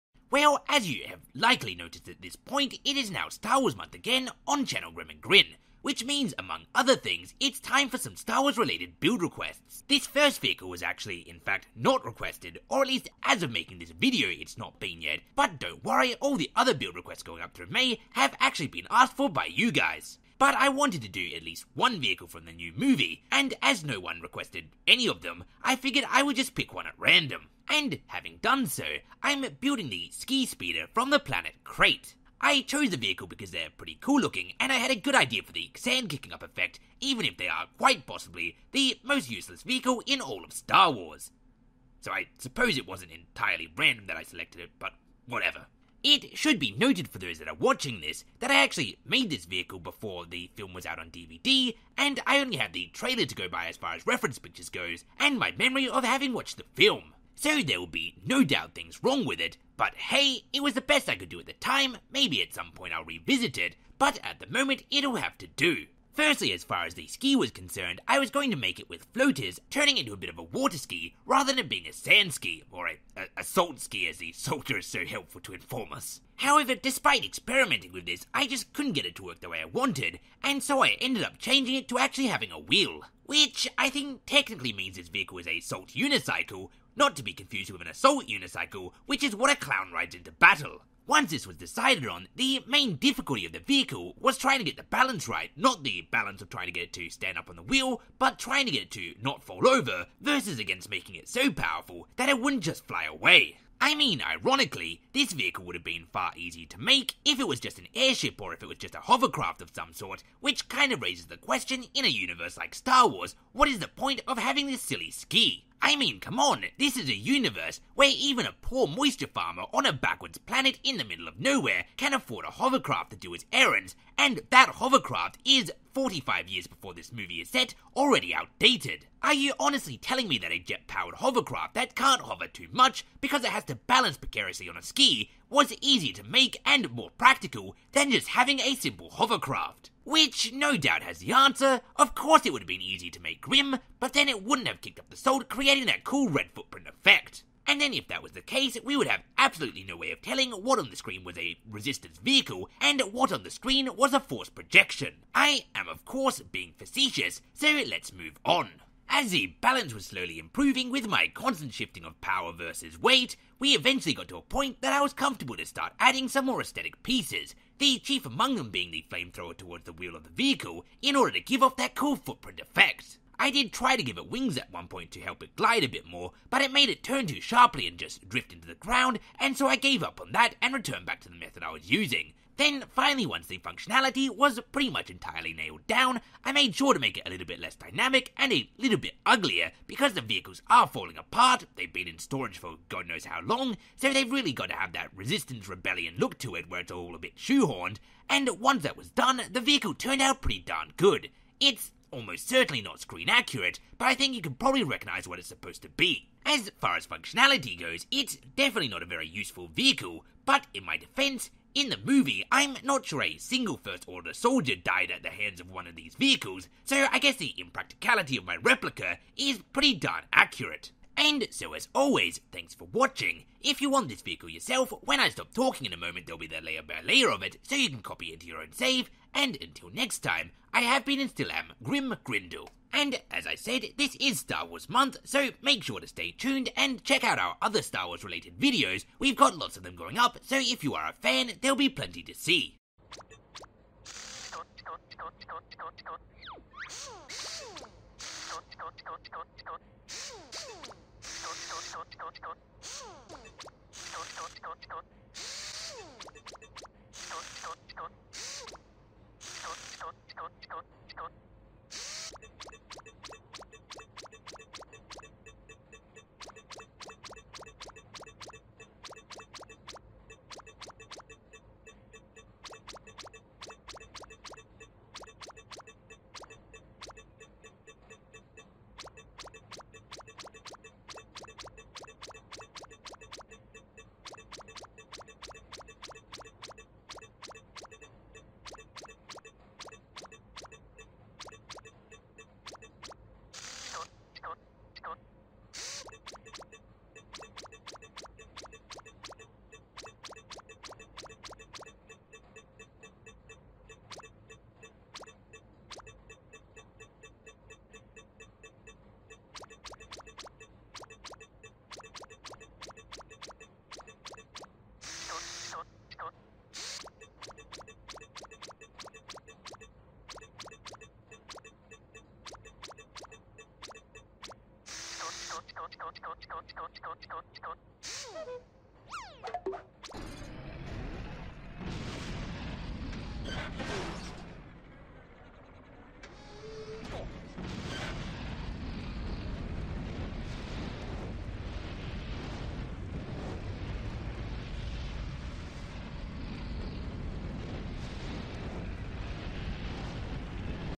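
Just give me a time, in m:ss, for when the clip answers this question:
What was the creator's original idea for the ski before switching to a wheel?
1:09.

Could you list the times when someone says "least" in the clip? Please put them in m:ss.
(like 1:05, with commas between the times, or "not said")
0:12, 0:21.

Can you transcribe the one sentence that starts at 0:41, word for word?
So I suppose it wasn't entirely random that I selected it, but whatever.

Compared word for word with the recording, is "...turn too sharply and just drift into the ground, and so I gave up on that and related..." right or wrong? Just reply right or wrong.
wrong.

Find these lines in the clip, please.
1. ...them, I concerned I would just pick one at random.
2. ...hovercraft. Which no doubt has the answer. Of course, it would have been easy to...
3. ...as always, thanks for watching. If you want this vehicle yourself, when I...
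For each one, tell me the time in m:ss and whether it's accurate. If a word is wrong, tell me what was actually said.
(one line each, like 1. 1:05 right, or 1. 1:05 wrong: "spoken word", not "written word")
1. 0:25 wrong: "figured", not "concerned"
2. 2:19 right
3. 3:41 right.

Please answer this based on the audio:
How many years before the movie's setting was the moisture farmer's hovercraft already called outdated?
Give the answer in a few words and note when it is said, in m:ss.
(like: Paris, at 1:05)
45, at 2:05.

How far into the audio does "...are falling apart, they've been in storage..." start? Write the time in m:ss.
3:10.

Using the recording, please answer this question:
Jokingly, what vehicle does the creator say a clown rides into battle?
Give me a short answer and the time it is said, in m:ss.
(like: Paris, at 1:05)
an assault unicycle, at 1:27.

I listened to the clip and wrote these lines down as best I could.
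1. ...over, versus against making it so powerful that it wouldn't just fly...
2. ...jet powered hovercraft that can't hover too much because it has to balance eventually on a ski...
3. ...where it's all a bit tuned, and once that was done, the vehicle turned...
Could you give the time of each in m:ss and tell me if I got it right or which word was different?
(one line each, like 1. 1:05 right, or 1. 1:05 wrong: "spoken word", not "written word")
1. 1:39 right
2. 2:10 wrong: "precariously", not "eventually"
3. 3:16 wrong: "shoehorned", not "tuned".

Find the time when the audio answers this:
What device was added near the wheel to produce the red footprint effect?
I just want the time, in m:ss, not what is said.
2:49.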